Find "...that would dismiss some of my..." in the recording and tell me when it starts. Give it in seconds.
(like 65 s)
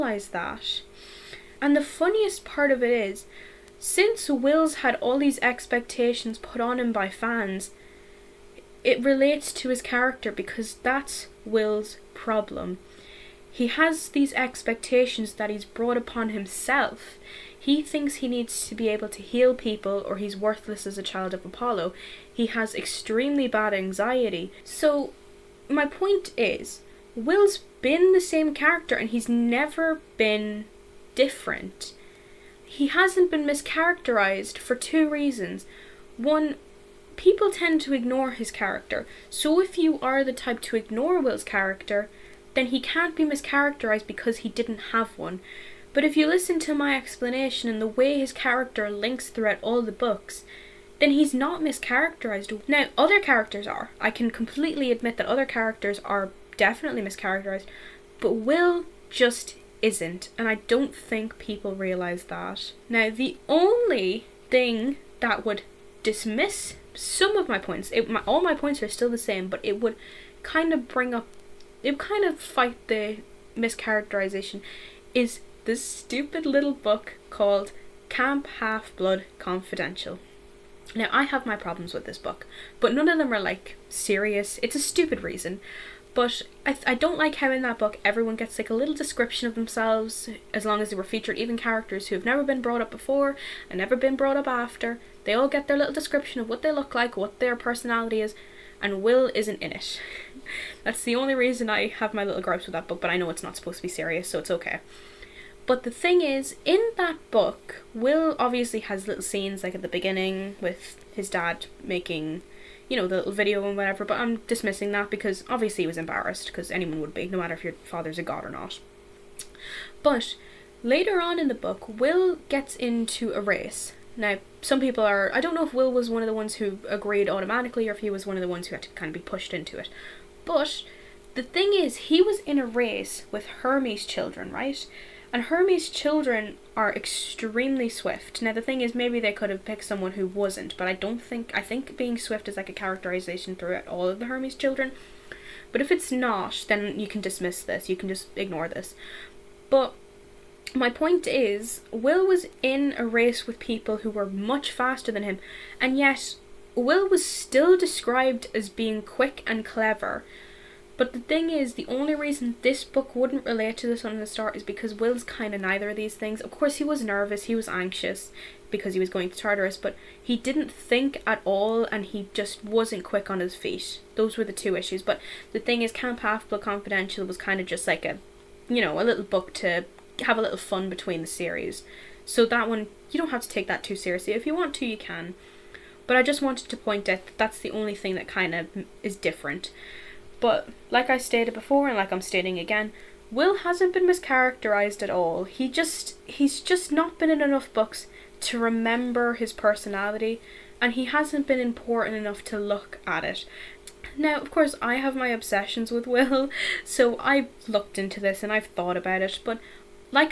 65 s.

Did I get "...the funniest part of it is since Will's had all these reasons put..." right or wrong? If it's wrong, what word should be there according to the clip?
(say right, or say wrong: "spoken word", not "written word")
wrong: "expectations", not "reasons".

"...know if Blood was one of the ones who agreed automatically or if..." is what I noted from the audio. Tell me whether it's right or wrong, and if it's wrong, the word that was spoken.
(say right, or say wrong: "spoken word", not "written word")
wrong: "Will", not "Blood".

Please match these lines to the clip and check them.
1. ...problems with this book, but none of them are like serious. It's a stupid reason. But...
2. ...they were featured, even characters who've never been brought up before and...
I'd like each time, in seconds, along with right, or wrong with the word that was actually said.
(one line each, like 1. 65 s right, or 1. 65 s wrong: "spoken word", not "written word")
1. 81 s right
2. 90 s right.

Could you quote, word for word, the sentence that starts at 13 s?
He has these expectations that he's brought upon himself.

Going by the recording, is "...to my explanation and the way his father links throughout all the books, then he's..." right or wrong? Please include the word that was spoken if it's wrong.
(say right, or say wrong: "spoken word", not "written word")
wrong: "character", not "father".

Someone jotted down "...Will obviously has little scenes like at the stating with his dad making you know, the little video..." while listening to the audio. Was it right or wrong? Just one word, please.
wrong.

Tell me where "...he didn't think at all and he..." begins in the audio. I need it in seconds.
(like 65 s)
170 s.